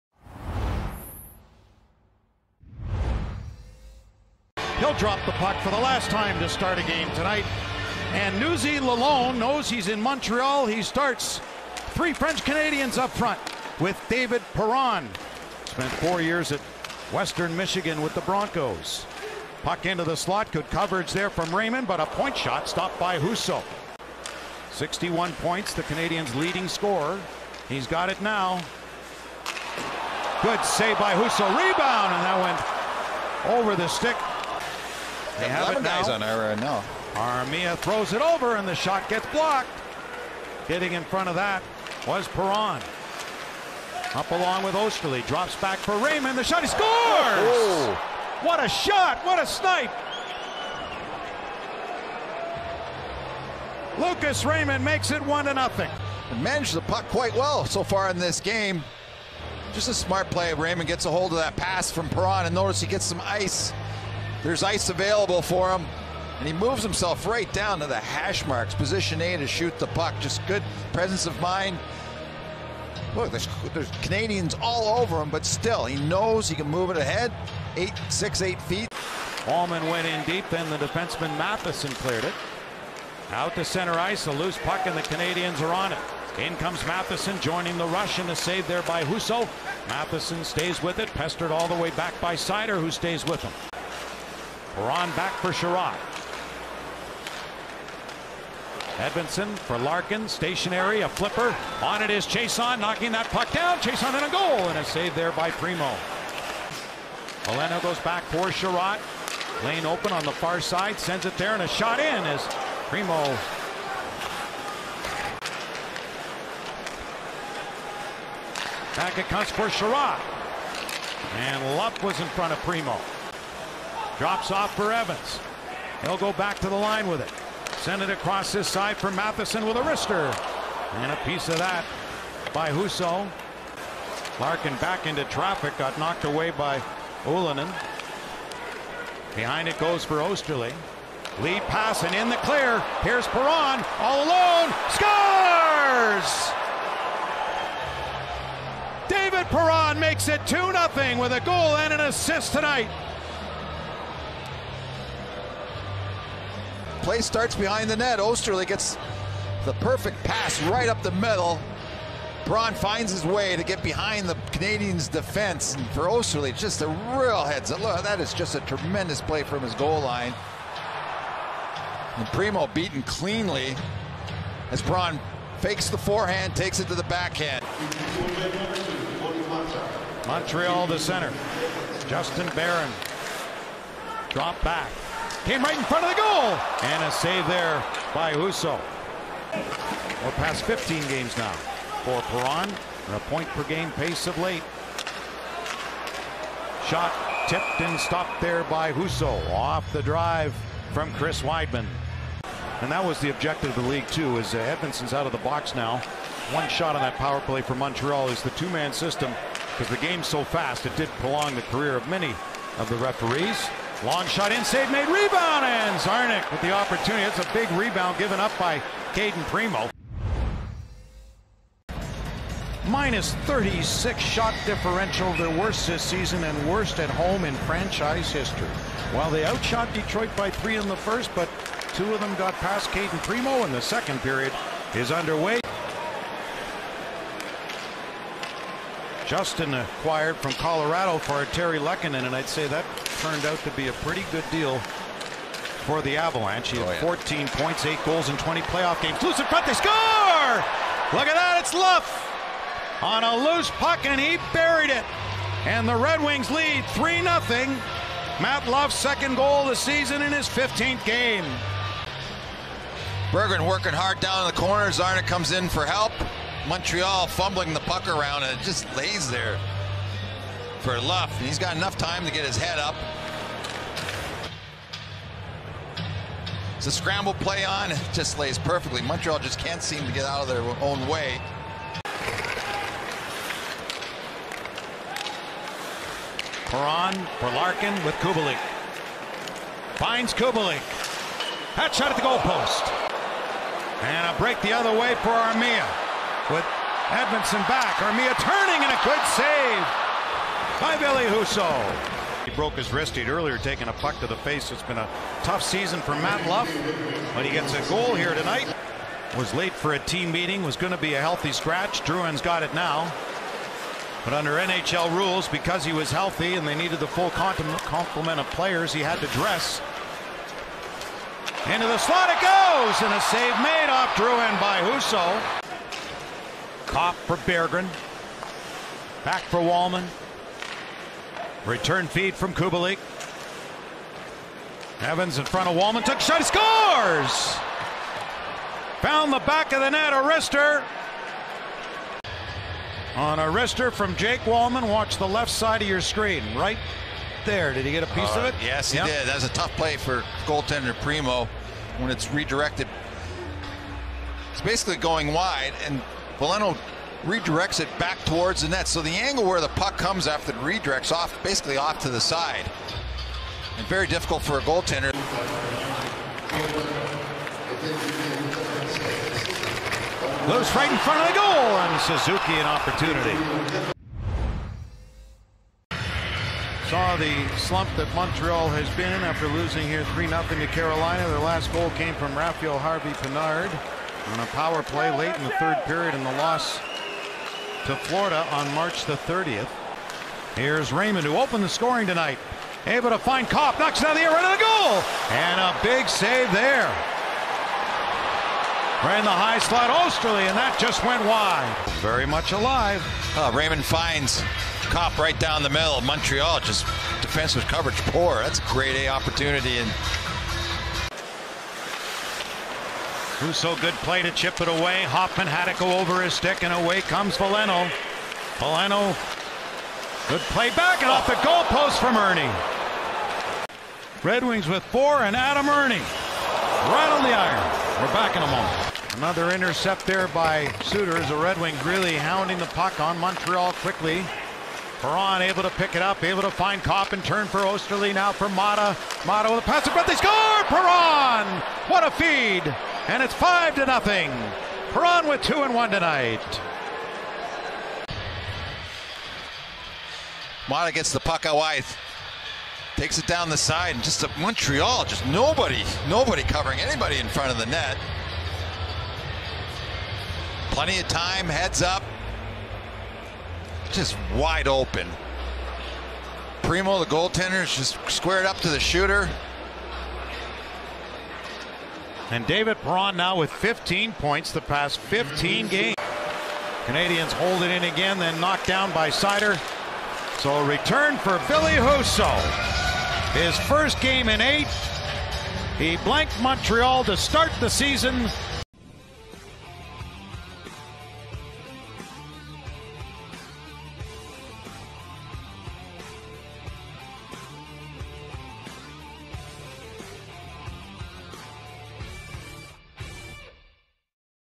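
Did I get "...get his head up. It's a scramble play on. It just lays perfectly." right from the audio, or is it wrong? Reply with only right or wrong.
right.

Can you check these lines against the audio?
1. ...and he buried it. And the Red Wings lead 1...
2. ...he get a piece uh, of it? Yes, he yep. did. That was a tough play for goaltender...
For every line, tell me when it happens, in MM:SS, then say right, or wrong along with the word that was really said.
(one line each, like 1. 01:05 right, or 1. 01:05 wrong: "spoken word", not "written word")
1. 04:14 wrong: "3", not "1"
2. 05:47 right.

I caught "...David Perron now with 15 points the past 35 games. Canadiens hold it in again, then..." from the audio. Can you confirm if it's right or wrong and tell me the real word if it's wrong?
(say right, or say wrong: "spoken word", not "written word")
wrong: "15", not "35".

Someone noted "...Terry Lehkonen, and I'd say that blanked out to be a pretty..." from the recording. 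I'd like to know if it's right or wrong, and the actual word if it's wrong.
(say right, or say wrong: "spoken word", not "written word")
wrong: "turned", not "blanked".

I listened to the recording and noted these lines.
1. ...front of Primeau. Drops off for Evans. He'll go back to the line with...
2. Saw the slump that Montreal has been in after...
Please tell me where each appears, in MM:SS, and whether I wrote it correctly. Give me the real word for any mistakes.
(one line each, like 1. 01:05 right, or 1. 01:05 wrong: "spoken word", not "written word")
1. 02:02 right
2. 06:16 right.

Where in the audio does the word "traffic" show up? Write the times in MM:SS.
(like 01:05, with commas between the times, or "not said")
02:15.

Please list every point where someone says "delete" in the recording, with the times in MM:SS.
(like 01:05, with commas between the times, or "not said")
not said.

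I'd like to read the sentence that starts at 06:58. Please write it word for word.
Veleno, good play back and off the goalpost from Erne.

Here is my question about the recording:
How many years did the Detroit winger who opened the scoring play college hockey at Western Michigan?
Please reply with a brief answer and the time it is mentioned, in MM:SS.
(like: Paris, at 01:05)
4, at 00:15.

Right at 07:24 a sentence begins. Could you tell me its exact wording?
Perron with two and one tonight.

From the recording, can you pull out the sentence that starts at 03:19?
Off the drive from Chris Wideman.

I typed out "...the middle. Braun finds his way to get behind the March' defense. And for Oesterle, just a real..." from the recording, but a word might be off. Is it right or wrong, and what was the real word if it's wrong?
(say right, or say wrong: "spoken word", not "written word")
wrong: "Canadiens", not "March".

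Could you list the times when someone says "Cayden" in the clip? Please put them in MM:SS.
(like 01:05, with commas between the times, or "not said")
03:39, 03:52.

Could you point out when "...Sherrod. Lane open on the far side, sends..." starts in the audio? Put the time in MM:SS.
01:48.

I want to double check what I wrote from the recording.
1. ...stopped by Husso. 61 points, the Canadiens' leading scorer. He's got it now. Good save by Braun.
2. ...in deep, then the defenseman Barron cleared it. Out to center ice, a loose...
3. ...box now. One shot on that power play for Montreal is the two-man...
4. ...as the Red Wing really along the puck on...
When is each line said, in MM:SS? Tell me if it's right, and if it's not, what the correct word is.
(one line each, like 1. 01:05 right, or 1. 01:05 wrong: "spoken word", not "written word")
1. 00:22 wrong: "Husso", not "Braun"
2. 01:20 wrong: "Matheson", not "Barron"
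3. 03:25 right
4. 07:11 wrong: "hounding", not "along".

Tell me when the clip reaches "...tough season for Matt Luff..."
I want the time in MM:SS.
05:05.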